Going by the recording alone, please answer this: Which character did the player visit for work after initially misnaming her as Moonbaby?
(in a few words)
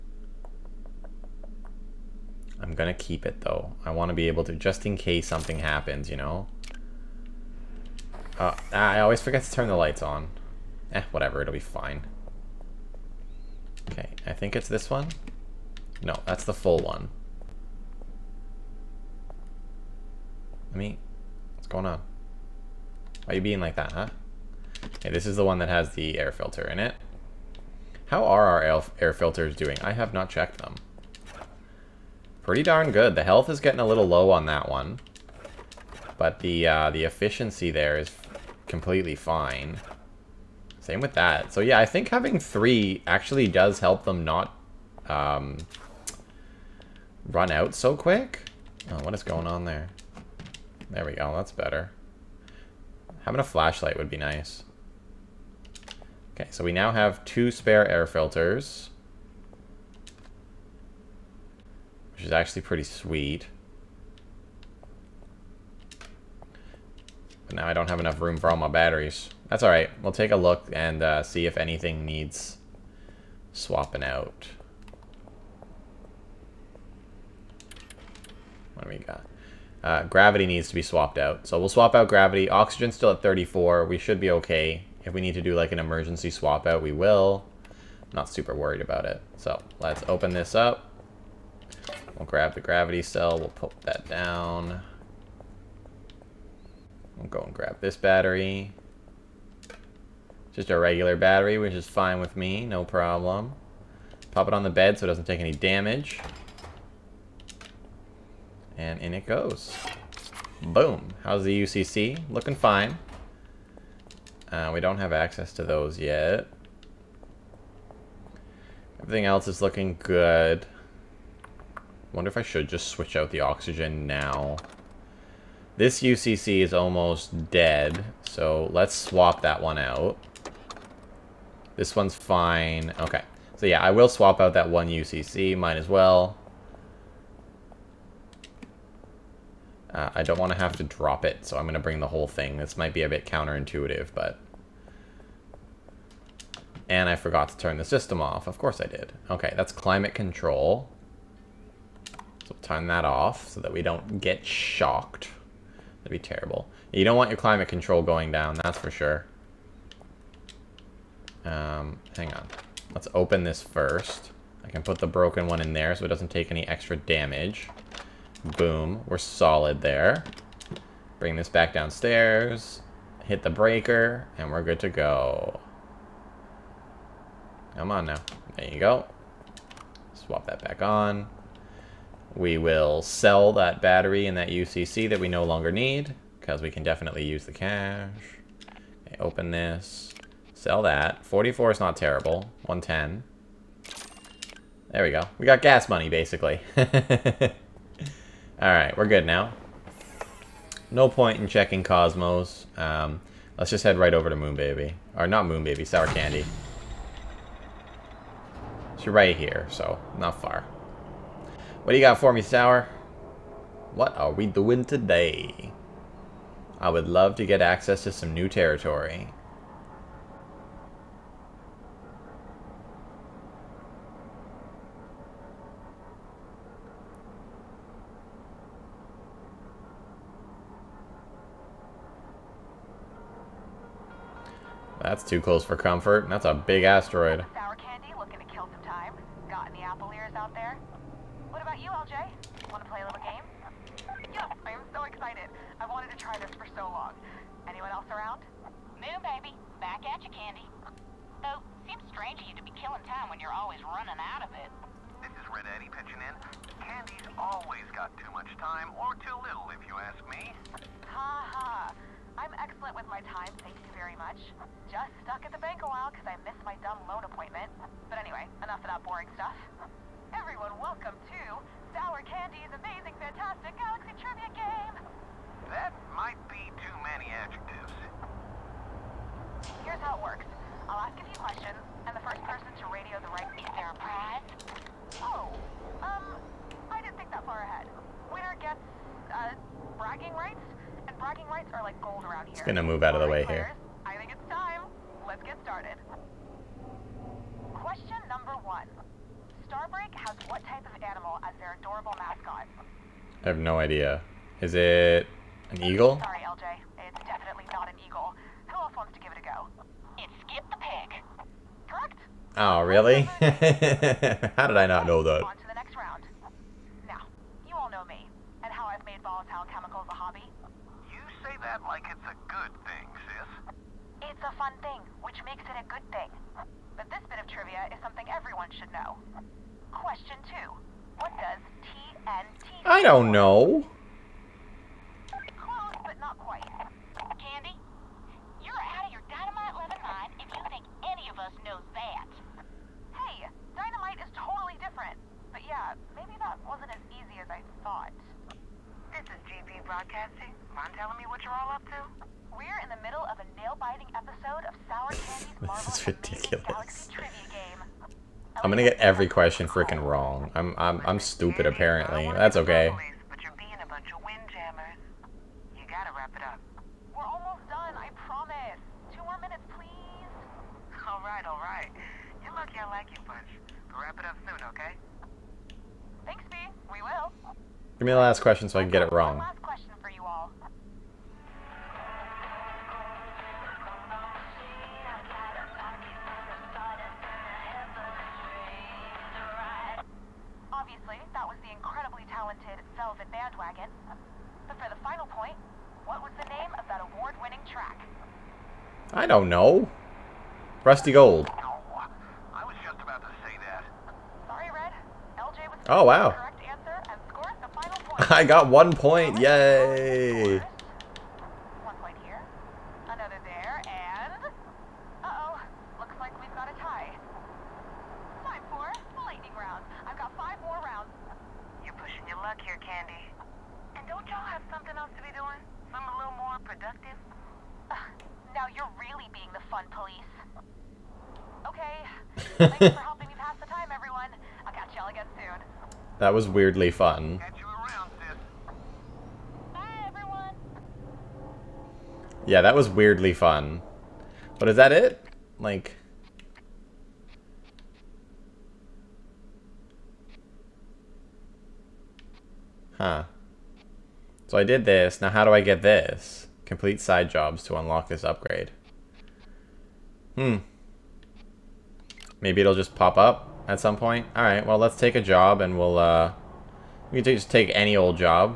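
Sour Candy.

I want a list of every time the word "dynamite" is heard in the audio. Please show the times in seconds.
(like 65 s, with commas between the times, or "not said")
339 s, 343 s.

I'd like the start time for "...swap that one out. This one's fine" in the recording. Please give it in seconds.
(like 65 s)
128 s.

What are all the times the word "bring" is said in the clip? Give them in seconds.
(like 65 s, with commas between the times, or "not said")
141 s, 171 s.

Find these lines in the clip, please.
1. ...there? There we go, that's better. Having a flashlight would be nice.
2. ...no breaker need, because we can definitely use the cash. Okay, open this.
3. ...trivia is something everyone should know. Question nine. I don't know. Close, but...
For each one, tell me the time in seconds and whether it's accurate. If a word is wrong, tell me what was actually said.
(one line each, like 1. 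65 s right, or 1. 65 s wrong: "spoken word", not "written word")
1. 49 s right
2. 185 s wrong: "longer", not "breaker"
3. 327 s wrong: "two", not "nine".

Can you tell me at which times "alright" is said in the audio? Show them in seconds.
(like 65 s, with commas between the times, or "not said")
69 s, 198 s.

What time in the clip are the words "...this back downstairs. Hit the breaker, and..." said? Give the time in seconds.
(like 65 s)
171 s.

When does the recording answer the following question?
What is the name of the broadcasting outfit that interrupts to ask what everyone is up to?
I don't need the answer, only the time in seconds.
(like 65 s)
349 s.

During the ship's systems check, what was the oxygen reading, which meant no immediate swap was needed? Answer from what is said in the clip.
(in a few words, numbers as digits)
34.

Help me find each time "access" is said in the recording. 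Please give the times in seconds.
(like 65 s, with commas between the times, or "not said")
115 s, 217 s.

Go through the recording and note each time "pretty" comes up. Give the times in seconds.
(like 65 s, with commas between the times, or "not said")
32 s, 62 s.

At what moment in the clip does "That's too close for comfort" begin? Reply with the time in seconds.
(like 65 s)
235 s.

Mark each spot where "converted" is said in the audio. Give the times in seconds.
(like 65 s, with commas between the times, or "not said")
not said.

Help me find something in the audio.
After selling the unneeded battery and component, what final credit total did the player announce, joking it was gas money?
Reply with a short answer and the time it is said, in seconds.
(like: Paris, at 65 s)
110, at 192 s.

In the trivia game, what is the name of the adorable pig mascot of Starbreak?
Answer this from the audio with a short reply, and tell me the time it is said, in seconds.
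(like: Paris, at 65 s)
Skip the Pig, at 310 s.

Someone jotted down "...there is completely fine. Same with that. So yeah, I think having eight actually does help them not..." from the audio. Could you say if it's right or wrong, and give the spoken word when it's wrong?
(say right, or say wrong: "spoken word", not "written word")
wrong: "three", not "eight".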